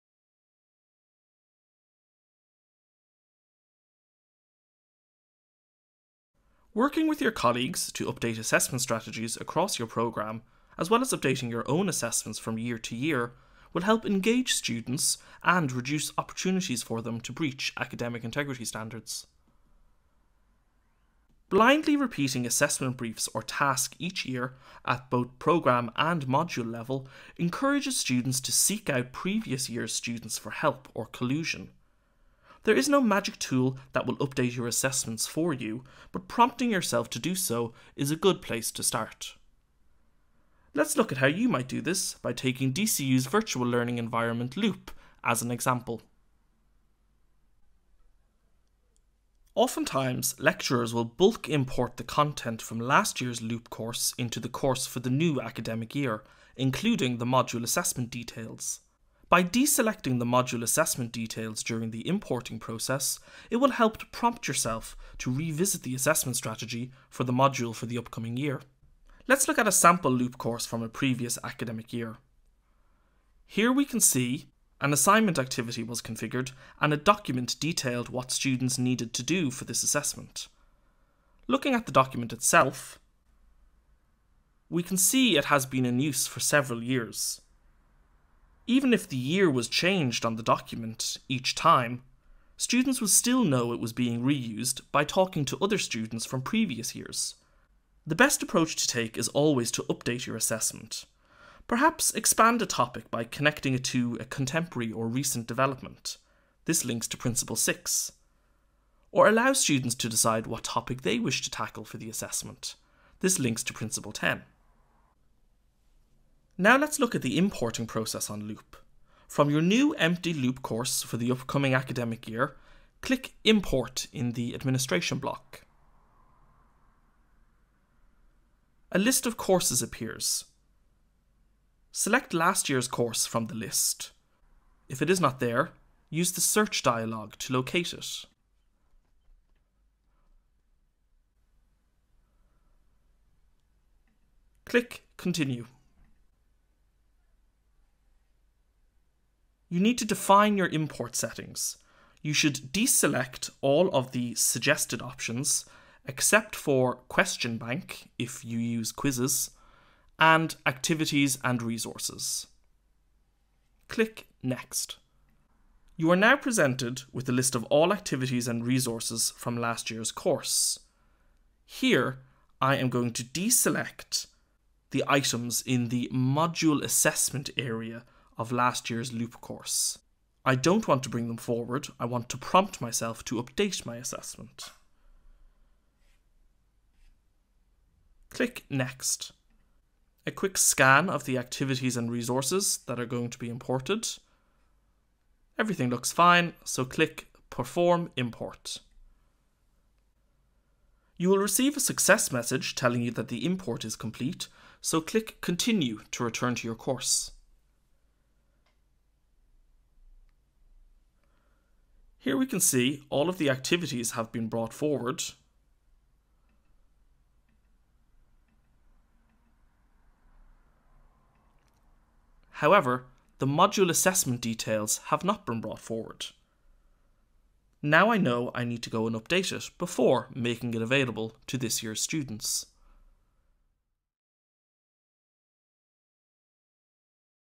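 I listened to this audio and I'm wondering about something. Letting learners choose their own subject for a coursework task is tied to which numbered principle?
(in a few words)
Principle 10.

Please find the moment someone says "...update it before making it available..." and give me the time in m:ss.
3:49.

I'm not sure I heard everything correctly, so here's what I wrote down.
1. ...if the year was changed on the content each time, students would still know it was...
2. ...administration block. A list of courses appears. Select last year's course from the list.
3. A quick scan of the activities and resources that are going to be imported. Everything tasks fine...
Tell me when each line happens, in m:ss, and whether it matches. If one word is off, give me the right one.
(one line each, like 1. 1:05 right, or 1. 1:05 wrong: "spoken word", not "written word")
1. 1:28 wrong: "document", not "content"
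2. 2:04 right
3. 3:10 wrong: "looks", not "tasks".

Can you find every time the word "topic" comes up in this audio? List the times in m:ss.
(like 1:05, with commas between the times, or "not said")
1:42, 1:50.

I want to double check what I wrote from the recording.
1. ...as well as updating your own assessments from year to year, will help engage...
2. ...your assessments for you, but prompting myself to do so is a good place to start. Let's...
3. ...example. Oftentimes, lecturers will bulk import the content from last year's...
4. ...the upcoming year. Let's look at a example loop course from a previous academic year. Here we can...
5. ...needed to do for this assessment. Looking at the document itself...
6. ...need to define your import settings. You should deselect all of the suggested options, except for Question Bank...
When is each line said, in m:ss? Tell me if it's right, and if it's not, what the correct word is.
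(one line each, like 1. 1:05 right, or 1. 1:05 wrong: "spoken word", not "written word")
1. 0:10 right
2. 0:34 wrong: "yourself", not "myself"
3. 0:45 right
4. 1:07 wrong: "sample", not "example"
5. 1:18 right
6. 2:29 right.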